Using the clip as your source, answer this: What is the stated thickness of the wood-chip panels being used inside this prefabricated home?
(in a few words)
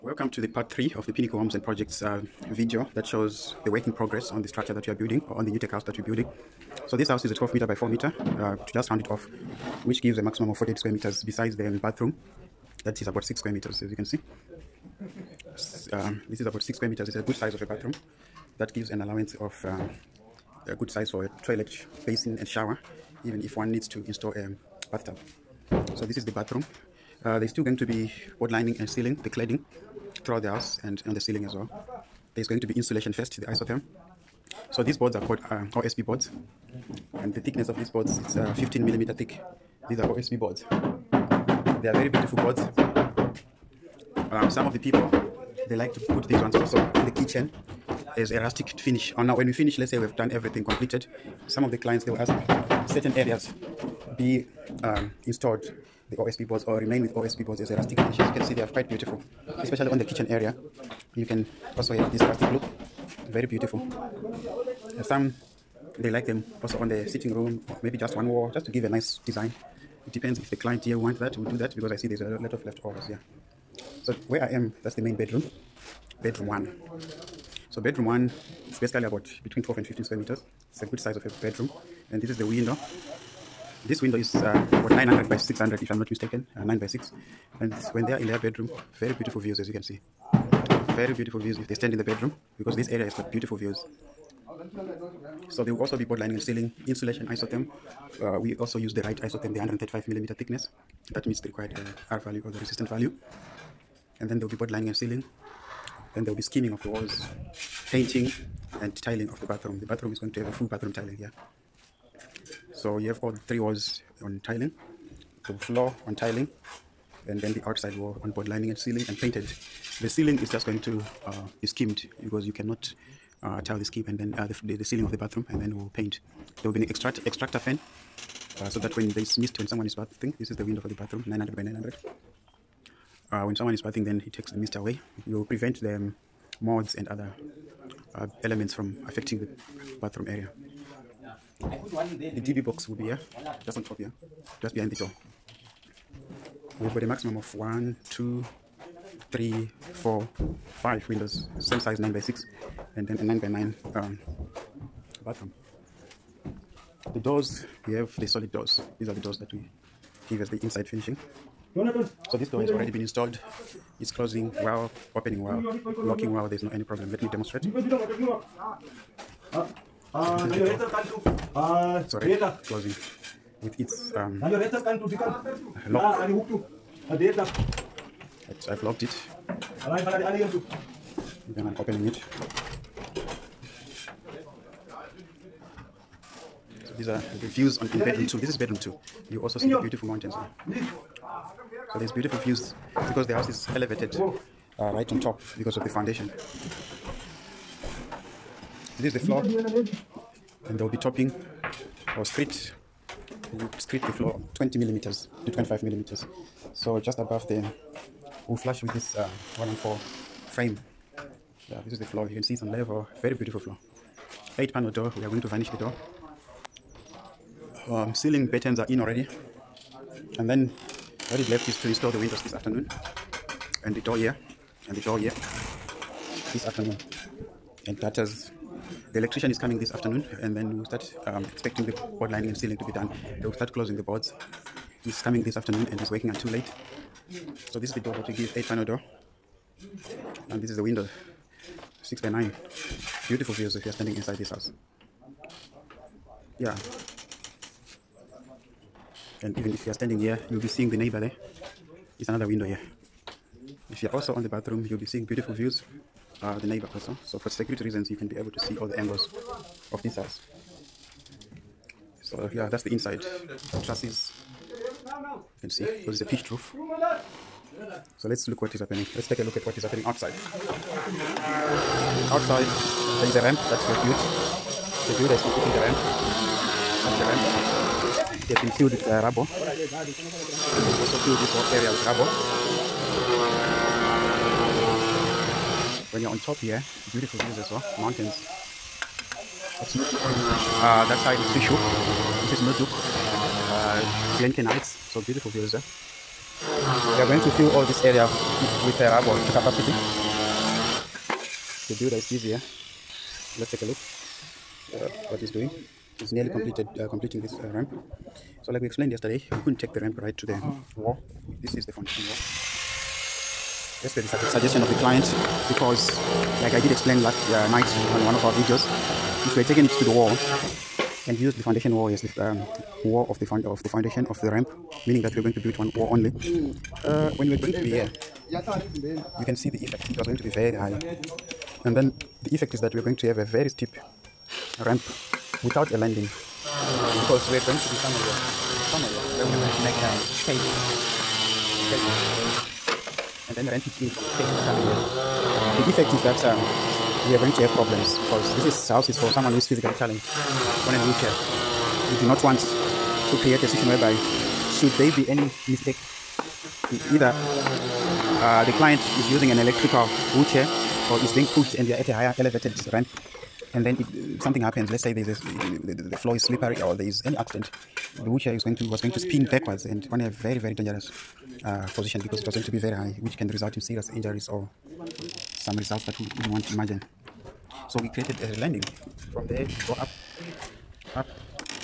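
15 millimeter.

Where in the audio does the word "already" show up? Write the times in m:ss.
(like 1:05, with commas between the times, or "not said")
2:42, 2:51, 3:39.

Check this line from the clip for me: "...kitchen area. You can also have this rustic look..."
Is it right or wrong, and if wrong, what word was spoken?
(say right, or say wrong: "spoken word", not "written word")
right.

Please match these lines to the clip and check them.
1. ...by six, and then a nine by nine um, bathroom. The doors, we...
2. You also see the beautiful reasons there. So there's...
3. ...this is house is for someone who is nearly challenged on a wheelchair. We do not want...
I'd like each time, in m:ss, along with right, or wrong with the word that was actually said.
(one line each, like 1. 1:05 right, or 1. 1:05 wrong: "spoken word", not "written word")
1. 2:32 right
2. 3:09 wrong: "mountains", not "reasons"
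3. 5:48 wrong: "physically", not "nearly".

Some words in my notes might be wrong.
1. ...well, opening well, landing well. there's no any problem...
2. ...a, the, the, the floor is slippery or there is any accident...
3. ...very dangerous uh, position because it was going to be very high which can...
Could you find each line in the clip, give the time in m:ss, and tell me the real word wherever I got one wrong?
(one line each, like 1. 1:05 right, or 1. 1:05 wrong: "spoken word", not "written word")
1. 2:44 wrong: "locking", not "landing"
2. 6:05 right
3. 6:10 right.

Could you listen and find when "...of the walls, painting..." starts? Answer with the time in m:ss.
1:46.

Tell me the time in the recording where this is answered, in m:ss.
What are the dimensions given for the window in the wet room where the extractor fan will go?
2:11.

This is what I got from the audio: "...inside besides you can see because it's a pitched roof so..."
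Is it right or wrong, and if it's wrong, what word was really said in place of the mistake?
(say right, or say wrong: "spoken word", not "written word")
wrong: "trusses", not "besides".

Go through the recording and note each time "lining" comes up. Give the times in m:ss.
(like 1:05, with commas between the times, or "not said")
0:28, 1:36, 1:44, 1:58, 3:52.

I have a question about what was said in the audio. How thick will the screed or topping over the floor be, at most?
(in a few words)
25 millimeters.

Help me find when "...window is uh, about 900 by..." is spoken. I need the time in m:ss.
1:24.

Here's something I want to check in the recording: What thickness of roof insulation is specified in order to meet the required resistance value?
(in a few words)
135 millimeter.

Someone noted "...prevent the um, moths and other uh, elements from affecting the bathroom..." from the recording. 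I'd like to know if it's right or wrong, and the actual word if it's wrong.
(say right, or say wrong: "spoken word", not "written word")
right.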